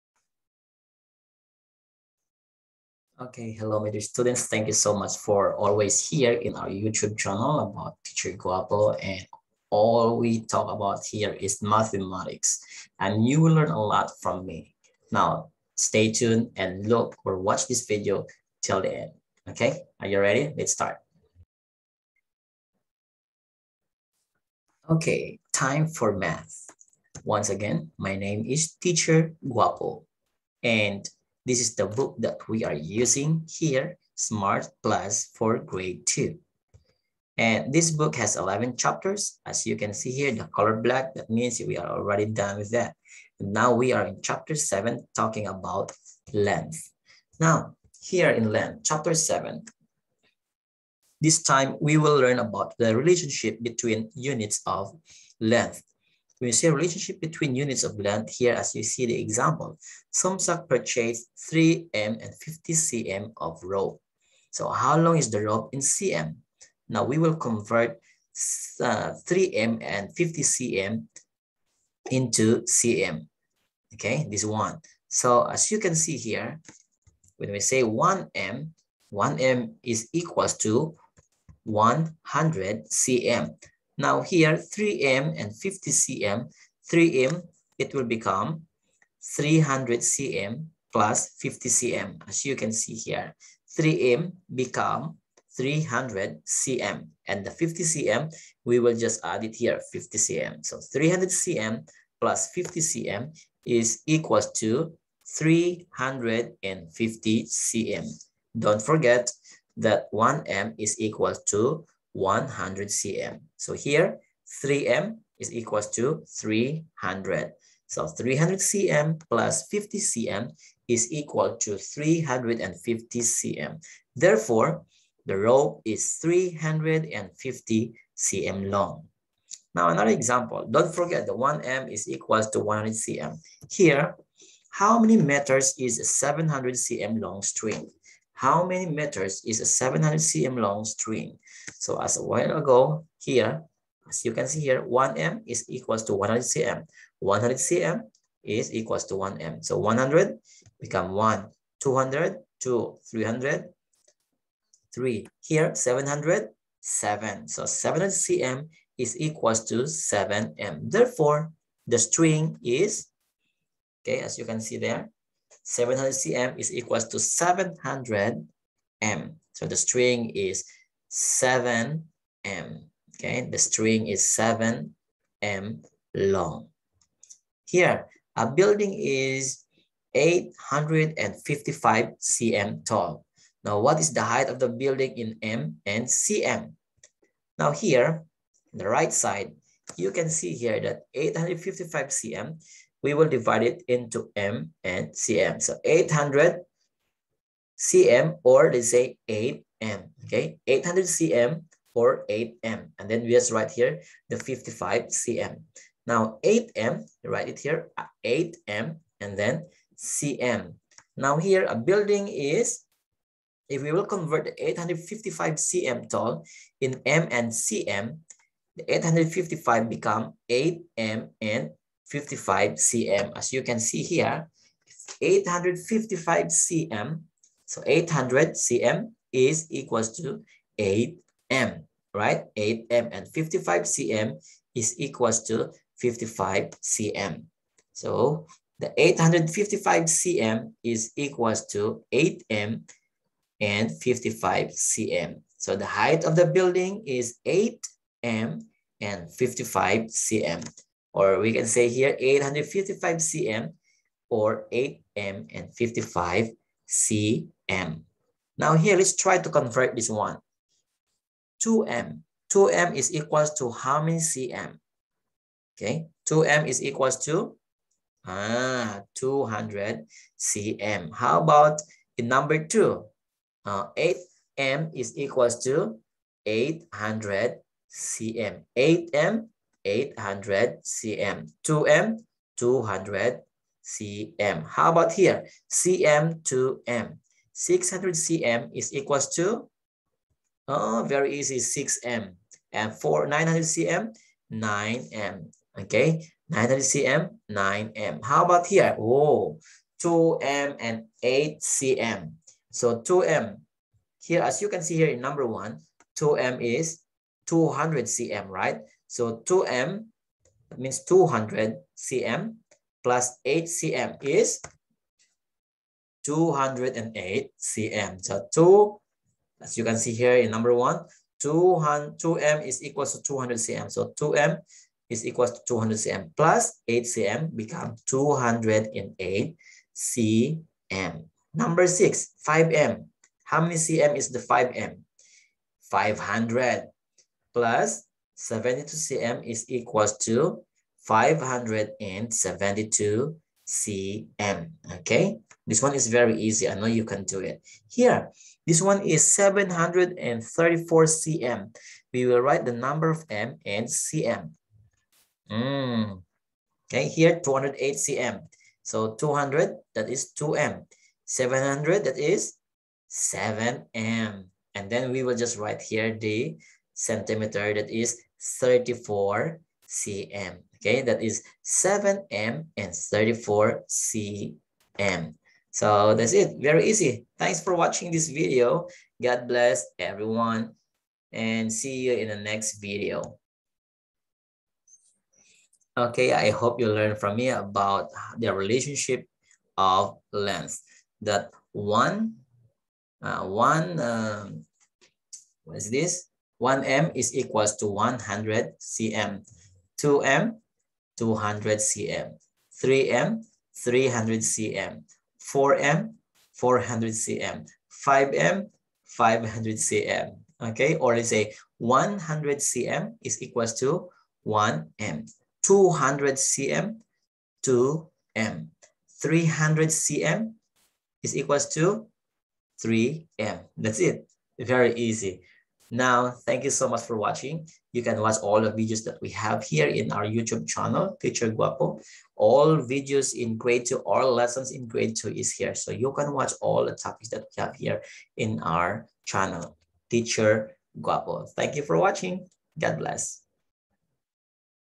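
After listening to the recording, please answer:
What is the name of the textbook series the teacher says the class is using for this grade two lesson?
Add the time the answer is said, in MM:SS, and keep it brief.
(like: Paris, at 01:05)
Smart Plus, at 00:34.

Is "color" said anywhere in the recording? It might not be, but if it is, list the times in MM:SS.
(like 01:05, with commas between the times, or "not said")
00:40.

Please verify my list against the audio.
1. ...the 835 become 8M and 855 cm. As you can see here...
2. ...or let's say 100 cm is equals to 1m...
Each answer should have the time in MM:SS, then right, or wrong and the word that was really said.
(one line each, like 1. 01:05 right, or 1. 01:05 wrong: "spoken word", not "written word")
1. 03:38 wrong: "855", not "835"
2. 06:51 right.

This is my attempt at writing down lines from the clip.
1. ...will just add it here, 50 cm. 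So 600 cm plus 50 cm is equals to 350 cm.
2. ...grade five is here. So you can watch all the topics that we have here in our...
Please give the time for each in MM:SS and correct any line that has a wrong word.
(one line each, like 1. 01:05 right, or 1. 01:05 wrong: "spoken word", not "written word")
1. 01:38 wrong: "300", not "600"
2. 07:14 wrong: "two", not "five".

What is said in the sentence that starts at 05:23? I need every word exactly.
So 2m is equal to 200 cm plus 8 cm become 208 cm.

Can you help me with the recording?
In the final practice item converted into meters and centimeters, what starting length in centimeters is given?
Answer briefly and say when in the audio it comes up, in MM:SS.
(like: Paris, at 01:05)
734 cm, at 05:49.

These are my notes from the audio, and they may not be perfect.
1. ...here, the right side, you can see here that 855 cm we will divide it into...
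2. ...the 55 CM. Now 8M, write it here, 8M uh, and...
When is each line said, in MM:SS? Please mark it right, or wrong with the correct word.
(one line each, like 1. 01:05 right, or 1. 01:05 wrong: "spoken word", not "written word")
1. 03:07 right
2. 03:24 right.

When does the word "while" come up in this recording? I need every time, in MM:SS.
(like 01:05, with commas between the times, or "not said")
02:22.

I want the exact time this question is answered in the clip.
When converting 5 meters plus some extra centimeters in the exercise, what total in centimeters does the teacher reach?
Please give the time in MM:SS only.
05:41.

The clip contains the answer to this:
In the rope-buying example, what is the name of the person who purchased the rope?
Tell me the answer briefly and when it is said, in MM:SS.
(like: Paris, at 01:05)
Somsak, at 01:00.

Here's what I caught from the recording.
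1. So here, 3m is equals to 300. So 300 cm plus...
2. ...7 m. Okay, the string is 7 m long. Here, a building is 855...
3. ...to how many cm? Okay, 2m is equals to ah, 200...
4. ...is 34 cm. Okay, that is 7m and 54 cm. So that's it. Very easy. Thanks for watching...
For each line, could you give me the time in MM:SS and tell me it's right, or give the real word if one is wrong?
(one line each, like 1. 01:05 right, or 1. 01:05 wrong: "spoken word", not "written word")
1. 01:53 right
2. 02:51 right
3. 04:23 right
4. 06:07 wrong: "34", not "54".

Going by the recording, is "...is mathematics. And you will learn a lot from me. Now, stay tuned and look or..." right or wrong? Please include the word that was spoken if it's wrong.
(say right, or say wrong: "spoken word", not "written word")
right.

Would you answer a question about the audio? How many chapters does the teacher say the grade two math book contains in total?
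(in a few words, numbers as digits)
11.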